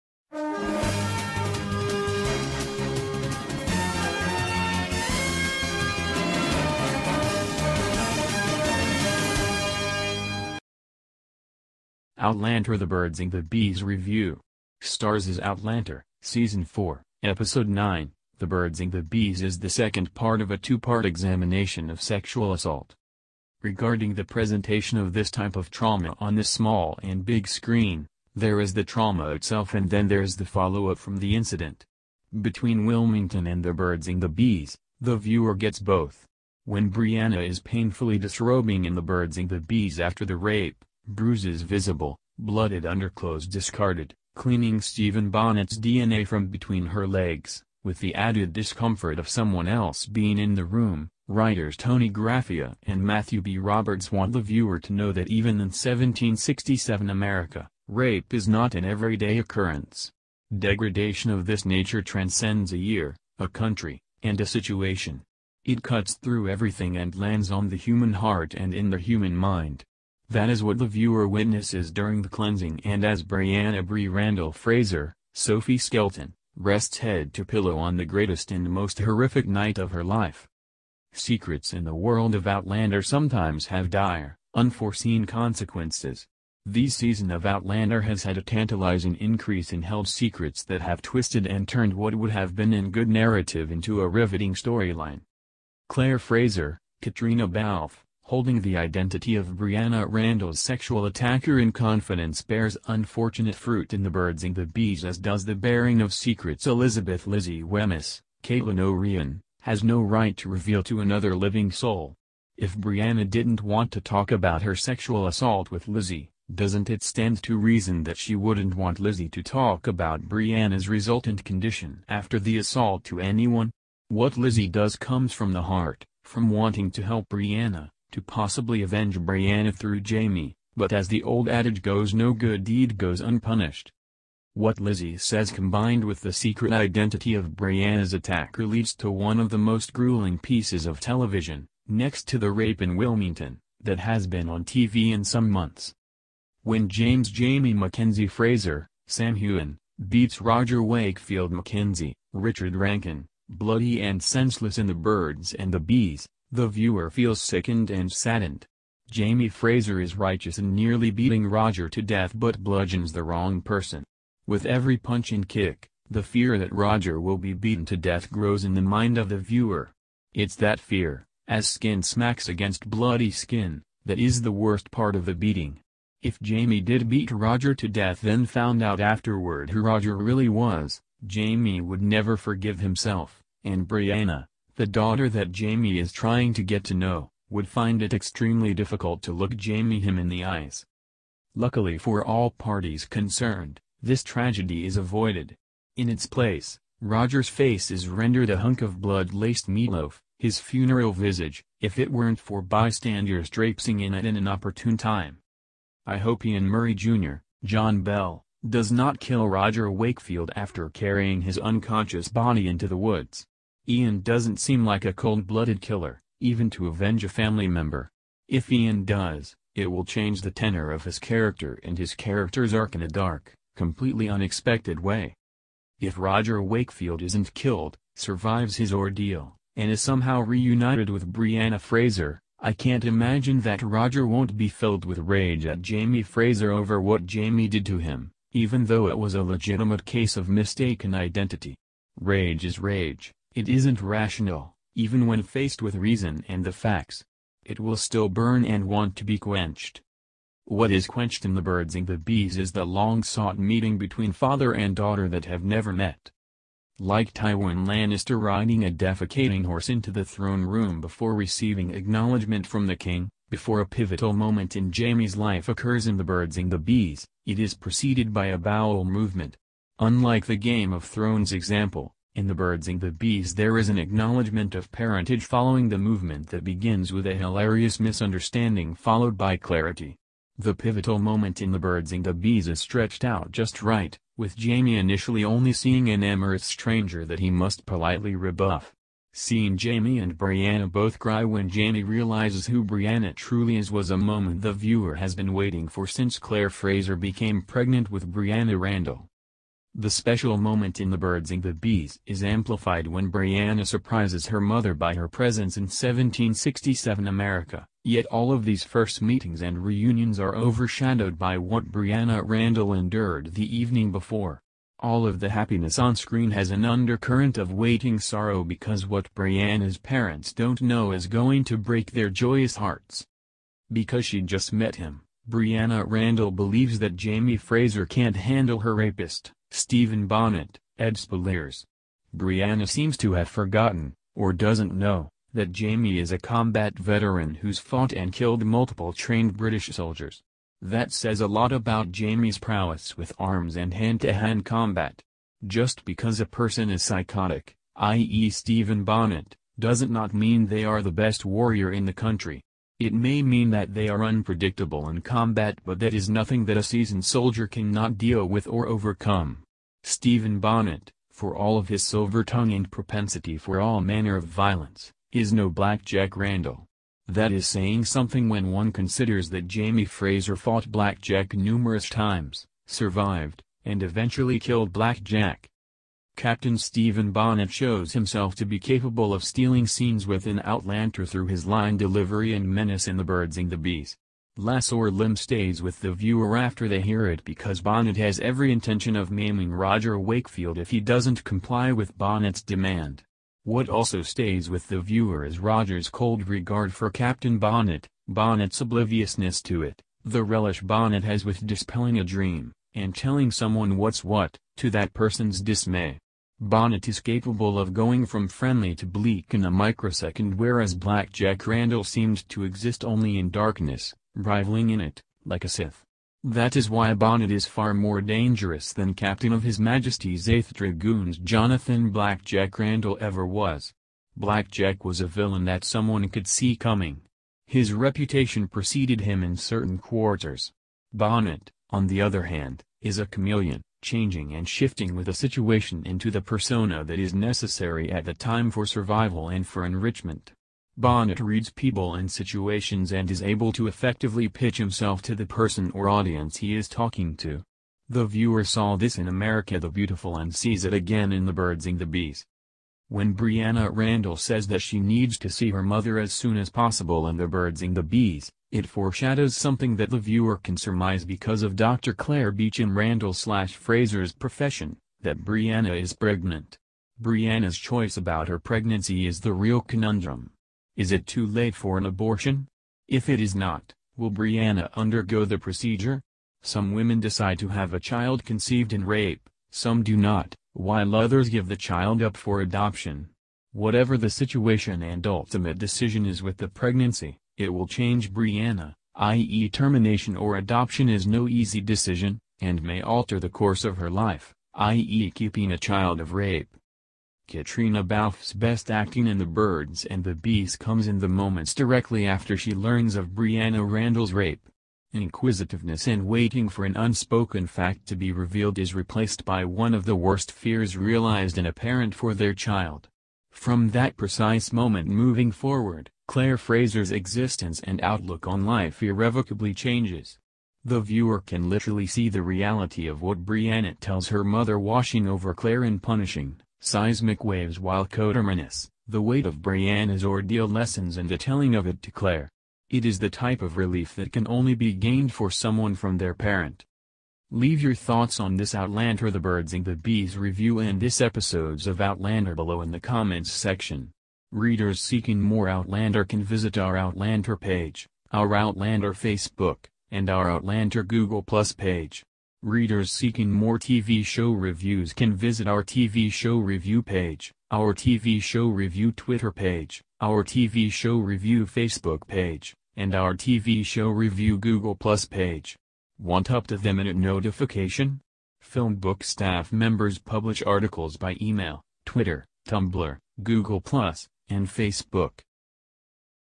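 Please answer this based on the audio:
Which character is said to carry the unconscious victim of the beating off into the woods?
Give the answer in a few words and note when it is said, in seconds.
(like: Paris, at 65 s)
Ian Murray Jr., at 206 s.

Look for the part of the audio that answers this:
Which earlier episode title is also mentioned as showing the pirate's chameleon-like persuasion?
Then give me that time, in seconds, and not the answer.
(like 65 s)
449 s.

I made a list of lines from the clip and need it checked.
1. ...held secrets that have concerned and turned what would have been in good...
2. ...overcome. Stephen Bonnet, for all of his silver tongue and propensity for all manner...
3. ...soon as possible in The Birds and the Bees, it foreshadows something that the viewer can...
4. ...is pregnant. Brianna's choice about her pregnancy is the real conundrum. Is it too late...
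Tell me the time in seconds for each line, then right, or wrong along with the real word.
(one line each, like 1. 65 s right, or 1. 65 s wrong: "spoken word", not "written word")
1. 89 s wrong: "twisted", not "concerned"
2. 358 s right
3. 456 s right
4. 466 s right.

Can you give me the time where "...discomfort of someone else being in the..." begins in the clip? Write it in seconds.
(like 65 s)
48 s.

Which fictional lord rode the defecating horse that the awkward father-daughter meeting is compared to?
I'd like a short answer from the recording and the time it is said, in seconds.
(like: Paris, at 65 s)
Tywin Lannister, at 257 s.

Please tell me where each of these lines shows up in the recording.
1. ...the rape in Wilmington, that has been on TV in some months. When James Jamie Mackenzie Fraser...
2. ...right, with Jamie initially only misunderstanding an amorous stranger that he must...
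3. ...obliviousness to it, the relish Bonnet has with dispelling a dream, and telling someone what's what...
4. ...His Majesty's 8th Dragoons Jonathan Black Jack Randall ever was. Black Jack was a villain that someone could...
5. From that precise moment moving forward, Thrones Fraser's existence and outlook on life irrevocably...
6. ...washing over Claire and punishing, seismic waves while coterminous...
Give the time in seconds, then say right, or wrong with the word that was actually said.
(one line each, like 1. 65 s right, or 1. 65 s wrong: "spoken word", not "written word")
1. 142 s right
2. 283 s wrong: "seeing", not "misunderstanding"
3. 398 s right
4. 419 s right
5. 513 s wrong: "Claire", not "Thrones"
6. 524 s right.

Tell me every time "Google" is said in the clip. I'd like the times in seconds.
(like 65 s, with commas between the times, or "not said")
551 s, 564 s, 573 s.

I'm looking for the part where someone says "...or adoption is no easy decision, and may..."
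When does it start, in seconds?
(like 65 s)
490 s.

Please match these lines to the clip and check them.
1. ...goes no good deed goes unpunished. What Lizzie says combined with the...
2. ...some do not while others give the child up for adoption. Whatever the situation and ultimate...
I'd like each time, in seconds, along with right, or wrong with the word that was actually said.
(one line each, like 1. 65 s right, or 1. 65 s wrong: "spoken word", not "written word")
1. 131 s right
2. 479 s right.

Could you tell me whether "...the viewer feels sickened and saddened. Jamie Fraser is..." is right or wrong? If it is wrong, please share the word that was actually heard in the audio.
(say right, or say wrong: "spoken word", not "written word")
right.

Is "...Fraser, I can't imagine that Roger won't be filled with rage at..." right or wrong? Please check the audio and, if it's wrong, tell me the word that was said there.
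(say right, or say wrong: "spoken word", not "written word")
right.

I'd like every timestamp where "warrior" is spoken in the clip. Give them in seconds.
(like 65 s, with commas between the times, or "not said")
351 s.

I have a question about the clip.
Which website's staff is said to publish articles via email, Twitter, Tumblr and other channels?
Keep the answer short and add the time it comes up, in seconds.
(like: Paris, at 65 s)
Filmbook, at 568 s.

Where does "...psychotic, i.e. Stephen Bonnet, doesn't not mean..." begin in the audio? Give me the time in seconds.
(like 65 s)
347 s.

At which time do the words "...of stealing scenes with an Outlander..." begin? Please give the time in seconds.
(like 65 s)
379 s.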